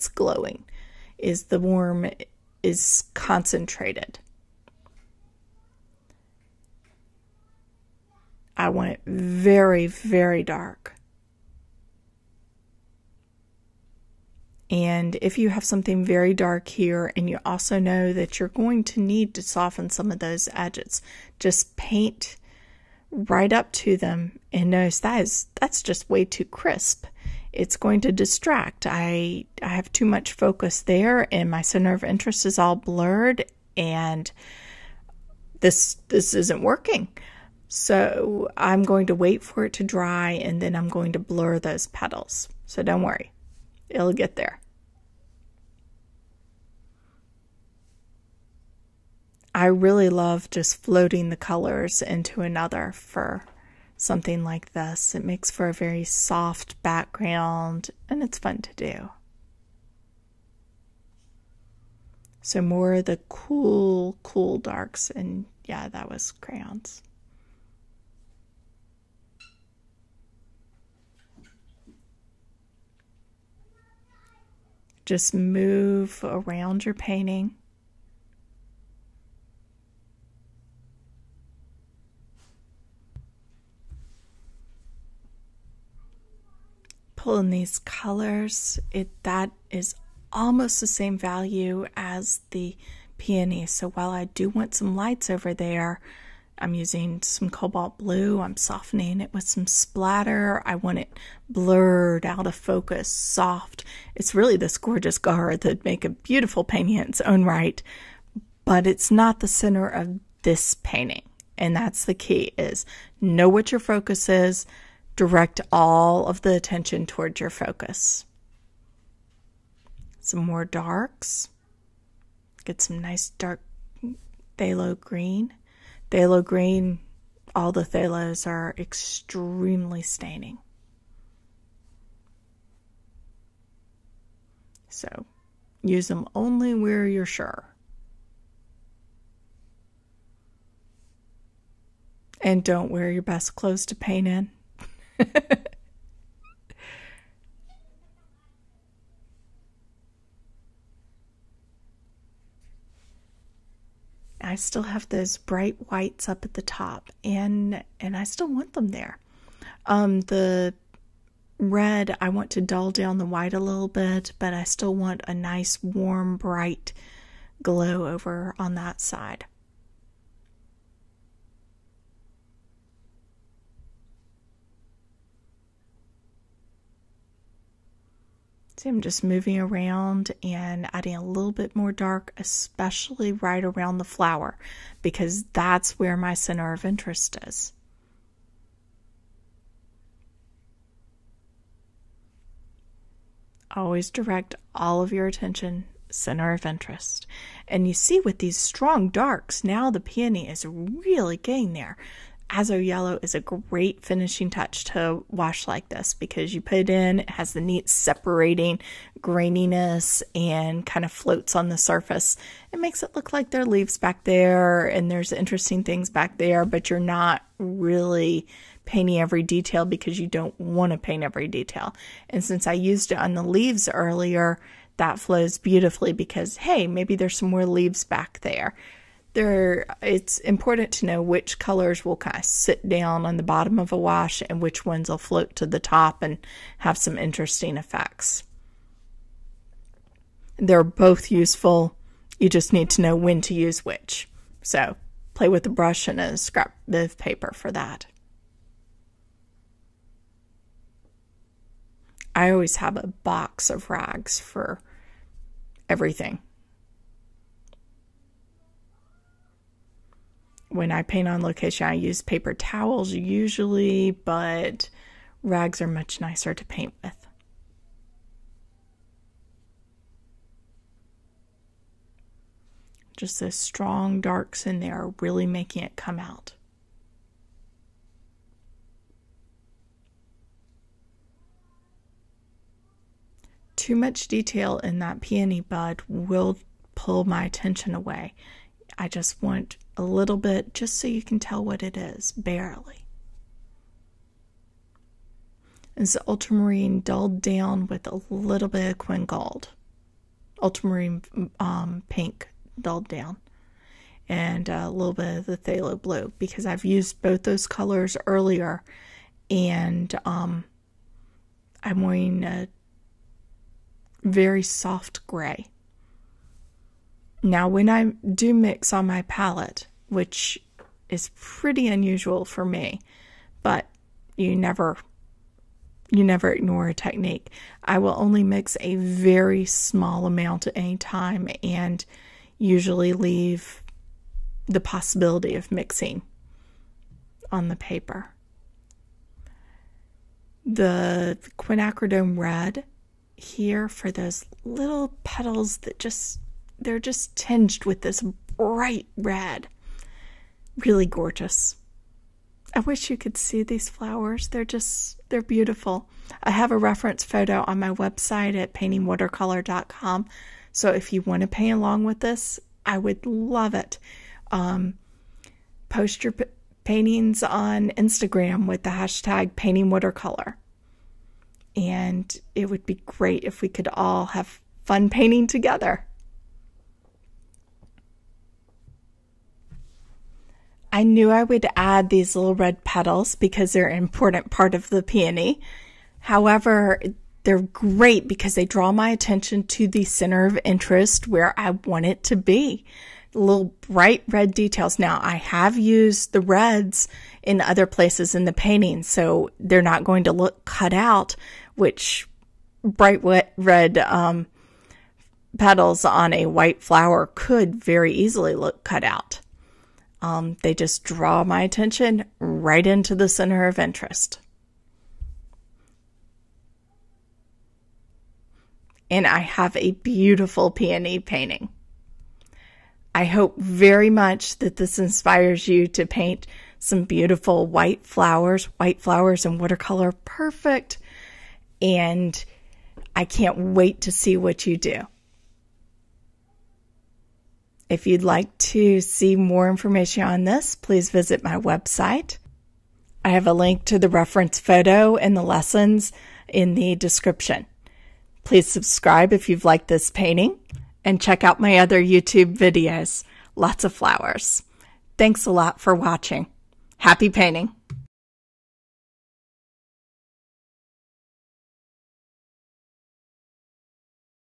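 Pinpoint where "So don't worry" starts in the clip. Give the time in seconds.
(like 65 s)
42 s.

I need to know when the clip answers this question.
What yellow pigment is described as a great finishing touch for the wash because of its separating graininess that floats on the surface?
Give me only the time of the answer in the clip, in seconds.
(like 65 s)
202 s.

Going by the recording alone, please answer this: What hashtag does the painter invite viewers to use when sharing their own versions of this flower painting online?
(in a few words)
paintingwatercolor.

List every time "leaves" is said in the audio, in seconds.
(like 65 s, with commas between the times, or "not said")
213 s, 223 s, 227 s, 333 s.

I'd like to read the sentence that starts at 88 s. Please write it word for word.
It that is almost the same value as the peony.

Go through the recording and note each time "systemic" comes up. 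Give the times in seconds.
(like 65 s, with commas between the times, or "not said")
not said.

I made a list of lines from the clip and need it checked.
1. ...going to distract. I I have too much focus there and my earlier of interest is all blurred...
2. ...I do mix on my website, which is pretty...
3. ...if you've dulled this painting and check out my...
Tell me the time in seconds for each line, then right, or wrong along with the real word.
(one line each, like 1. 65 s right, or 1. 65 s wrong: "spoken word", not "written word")
1. 27 s wrong: "center", not "earlier"
2. 317 s wrong: "palette", not "website"
3. 449 s wrong: "liked", not "dulled".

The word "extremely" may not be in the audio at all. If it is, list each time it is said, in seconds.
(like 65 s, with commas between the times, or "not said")
128 s.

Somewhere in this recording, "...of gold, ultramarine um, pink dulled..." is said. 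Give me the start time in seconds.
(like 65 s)
299 s.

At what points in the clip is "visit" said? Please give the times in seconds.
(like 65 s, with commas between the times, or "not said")
441 s.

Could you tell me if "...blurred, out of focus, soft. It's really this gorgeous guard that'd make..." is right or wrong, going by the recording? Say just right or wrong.
right.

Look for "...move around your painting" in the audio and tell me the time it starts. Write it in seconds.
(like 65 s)
75 s.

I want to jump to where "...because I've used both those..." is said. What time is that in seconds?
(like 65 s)
306 s.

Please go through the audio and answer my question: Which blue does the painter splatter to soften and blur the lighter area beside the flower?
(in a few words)
cobalt blue.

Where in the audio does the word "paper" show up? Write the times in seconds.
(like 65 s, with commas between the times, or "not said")
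247 s, 262 s, 337 s.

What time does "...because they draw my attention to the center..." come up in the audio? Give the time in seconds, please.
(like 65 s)
388 s.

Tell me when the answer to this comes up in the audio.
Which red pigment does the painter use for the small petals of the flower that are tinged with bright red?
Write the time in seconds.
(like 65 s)
341 s.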